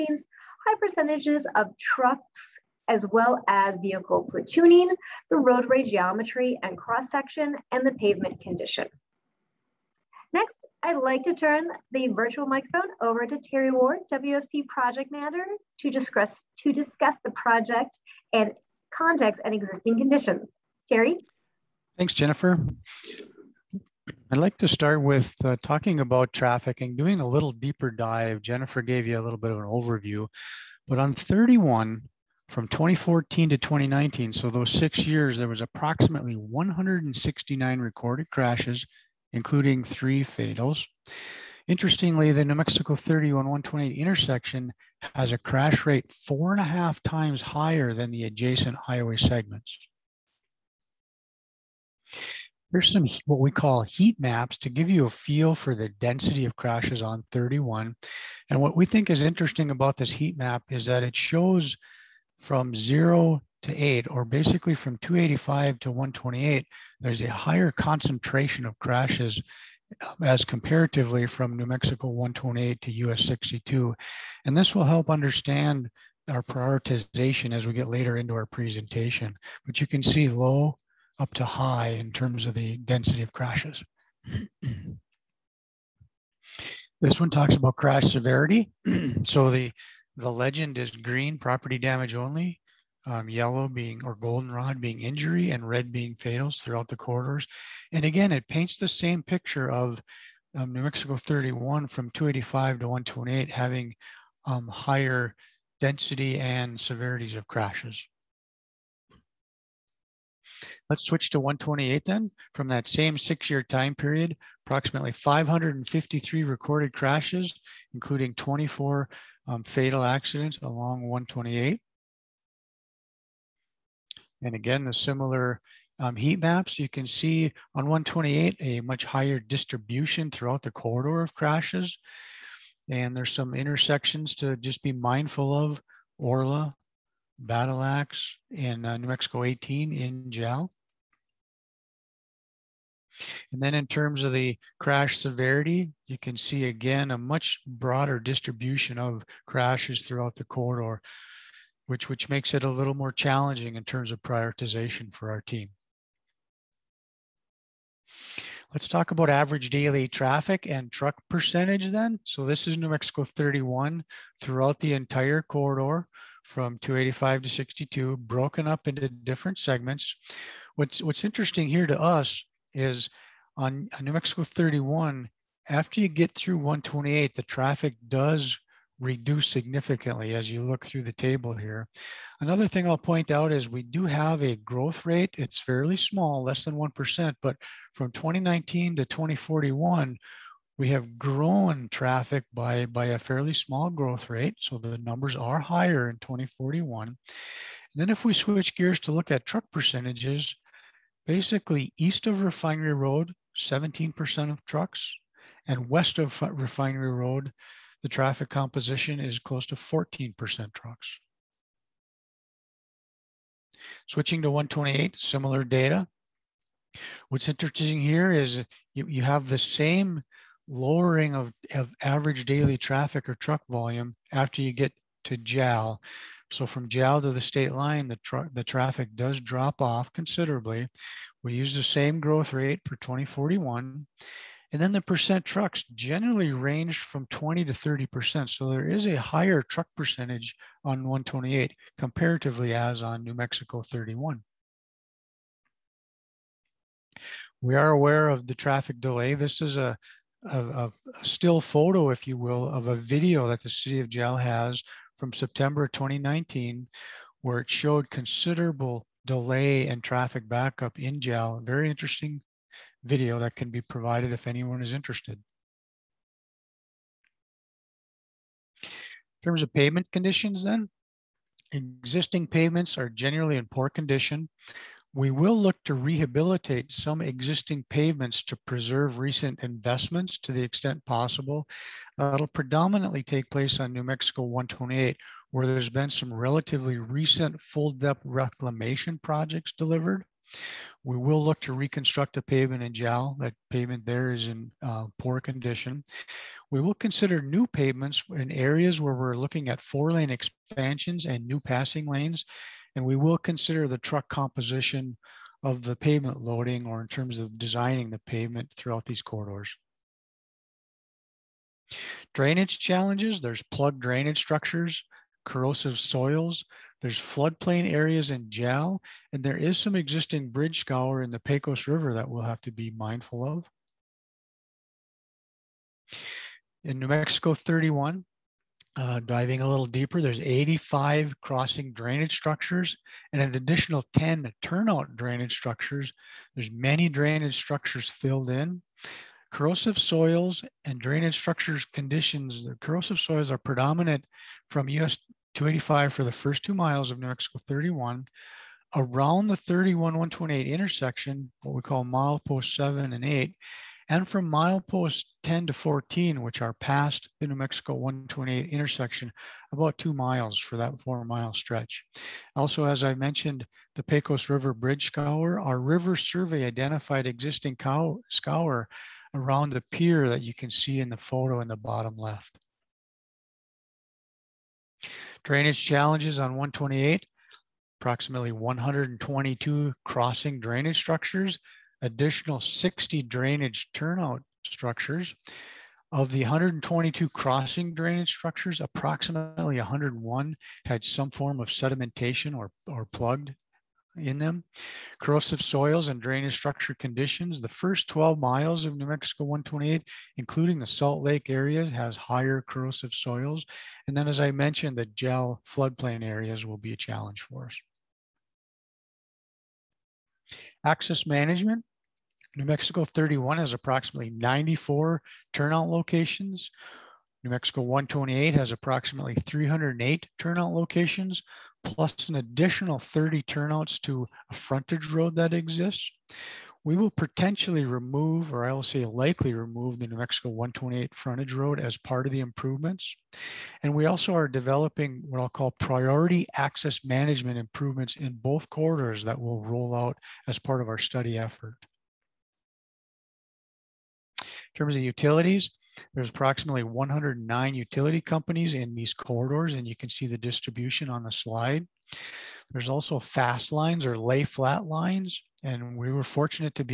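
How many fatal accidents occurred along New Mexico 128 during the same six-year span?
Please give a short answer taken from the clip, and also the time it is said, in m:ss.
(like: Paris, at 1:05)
24, at 1:58.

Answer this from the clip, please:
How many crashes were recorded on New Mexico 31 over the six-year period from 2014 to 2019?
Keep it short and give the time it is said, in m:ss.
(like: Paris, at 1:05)
169, at 0:36.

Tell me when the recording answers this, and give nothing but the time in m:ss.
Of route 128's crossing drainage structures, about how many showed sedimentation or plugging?
6:29.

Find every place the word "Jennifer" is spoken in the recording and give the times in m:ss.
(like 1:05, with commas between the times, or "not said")
0:22, 0:28.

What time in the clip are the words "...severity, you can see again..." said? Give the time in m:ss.
2:25.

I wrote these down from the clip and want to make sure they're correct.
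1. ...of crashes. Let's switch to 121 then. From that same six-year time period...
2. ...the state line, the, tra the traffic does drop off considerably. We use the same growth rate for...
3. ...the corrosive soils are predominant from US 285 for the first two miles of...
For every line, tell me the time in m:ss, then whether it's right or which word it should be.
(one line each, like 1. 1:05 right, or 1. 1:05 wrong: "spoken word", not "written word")
1. 1:47 wrong: "128", not "121"
2. 3:47 right
3. 5:42 right.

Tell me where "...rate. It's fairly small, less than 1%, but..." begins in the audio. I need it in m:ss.
3:05.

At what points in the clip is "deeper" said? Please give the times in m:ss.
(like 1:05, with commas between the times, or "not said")
0:27, 5:29.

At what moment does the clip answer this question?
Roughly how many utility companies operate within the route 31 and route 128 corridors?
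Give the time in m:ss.
7:26.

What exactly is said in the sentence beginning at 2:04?
And again, the similar um, heat maps, you can see on 128 a much higher distribution throughout the corridor of crashes.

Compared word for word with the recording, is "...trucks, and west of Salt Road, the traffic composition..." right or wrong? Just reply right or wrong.
wrong.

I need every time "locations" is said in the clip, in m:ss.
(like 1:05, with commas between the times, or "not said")
6:55, 7:00.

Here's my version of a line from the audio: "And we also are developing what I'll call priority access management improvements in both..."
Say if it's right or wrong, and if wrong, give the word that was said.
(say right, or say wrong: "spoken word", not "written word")
right.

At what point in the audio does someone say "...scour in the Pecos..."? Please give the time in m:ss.
5:20.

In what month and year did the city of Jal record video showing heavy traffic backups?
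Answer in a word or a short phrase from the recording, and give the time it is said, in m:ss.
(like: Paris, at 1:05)
September 2019, at 4:15.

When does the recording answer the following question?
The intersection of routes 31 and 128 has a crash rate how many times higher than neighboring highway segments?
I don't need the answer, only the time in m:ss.
0:46.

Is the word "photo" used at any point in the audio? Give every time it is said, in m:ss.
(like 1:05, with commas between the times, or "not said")
4:11, 6:11.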